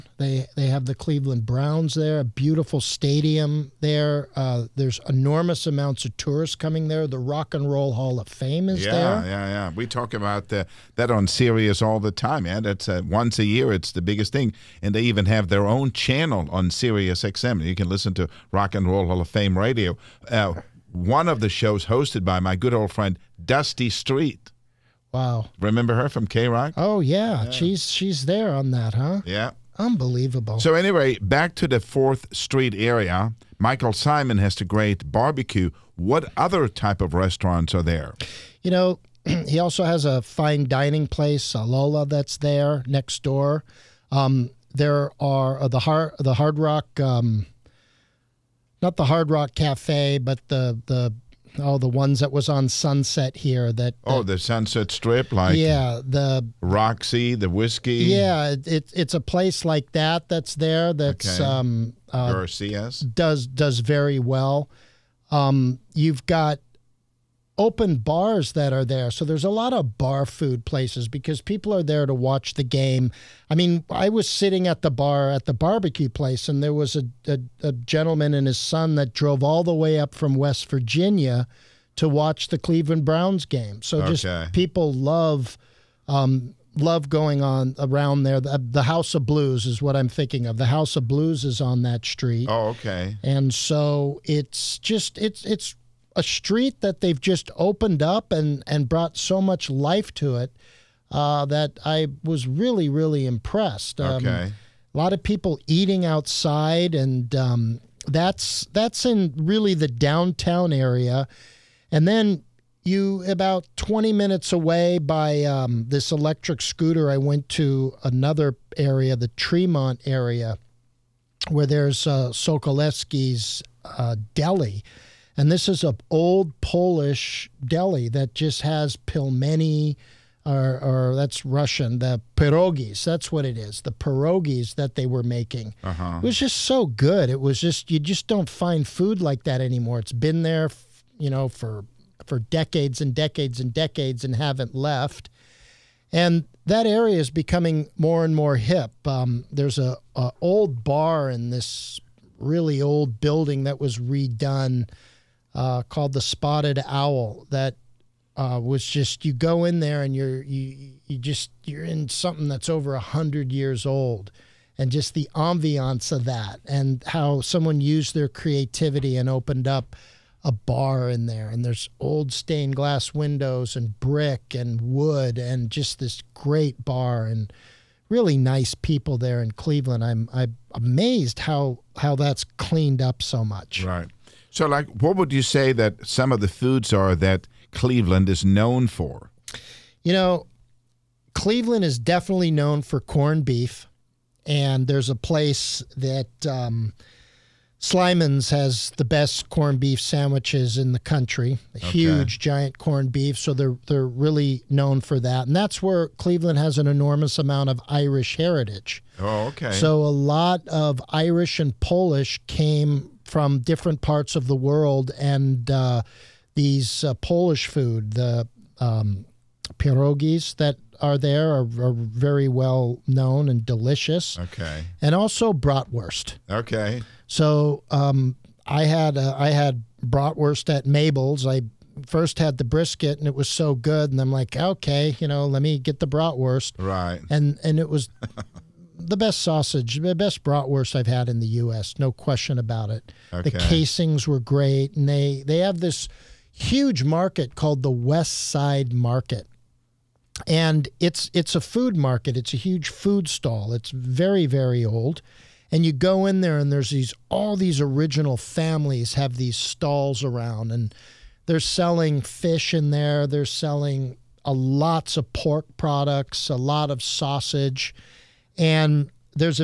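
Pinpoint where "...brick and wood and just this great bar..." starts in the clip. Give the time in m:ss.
2:53.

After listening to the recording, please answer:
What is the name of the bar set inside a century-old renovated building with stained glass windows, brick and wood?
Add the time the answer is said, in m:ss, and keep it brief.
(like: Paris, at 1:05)
Spotted Owl, at 2:36.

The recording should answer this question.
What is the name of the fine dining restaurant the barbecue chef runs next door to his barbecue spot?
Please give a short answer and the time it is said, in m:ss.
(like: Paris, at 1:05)
Lola, at 0:41.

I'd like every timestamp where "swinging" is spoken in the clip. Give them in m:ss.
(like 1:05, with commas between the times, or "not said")
not said.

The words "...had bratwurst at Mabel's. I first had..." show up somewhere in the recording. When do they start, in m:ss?
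3:49.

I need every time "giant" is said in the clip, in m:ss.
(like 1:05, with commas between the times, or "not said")
3:22.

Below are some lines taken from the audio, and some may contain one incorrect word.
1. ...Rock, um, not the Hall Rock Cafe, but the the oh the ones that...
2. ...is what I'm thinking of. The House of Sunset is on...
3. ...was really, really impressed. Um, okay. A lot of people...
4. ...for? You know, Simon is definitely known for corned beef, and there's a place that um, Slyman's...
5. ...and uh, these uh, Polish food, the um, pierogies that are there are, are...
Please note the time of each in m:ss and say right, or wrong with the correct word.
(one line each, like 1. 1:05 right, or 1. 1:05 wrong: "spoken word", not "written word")
1. 0:46 wrong: "Hard", not "Hall"
2. 1:29 wrong: "Blues", not "Sunset"
3. 1:42 right
4. 3:08 wrong: "Cleveland", not "Simon"
5. 3:35 right.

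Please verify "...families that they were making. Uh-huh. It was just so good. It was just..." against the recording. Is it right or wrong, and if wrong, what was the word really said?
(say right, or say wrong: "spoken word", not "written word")
wrong: "pierogies", not "families".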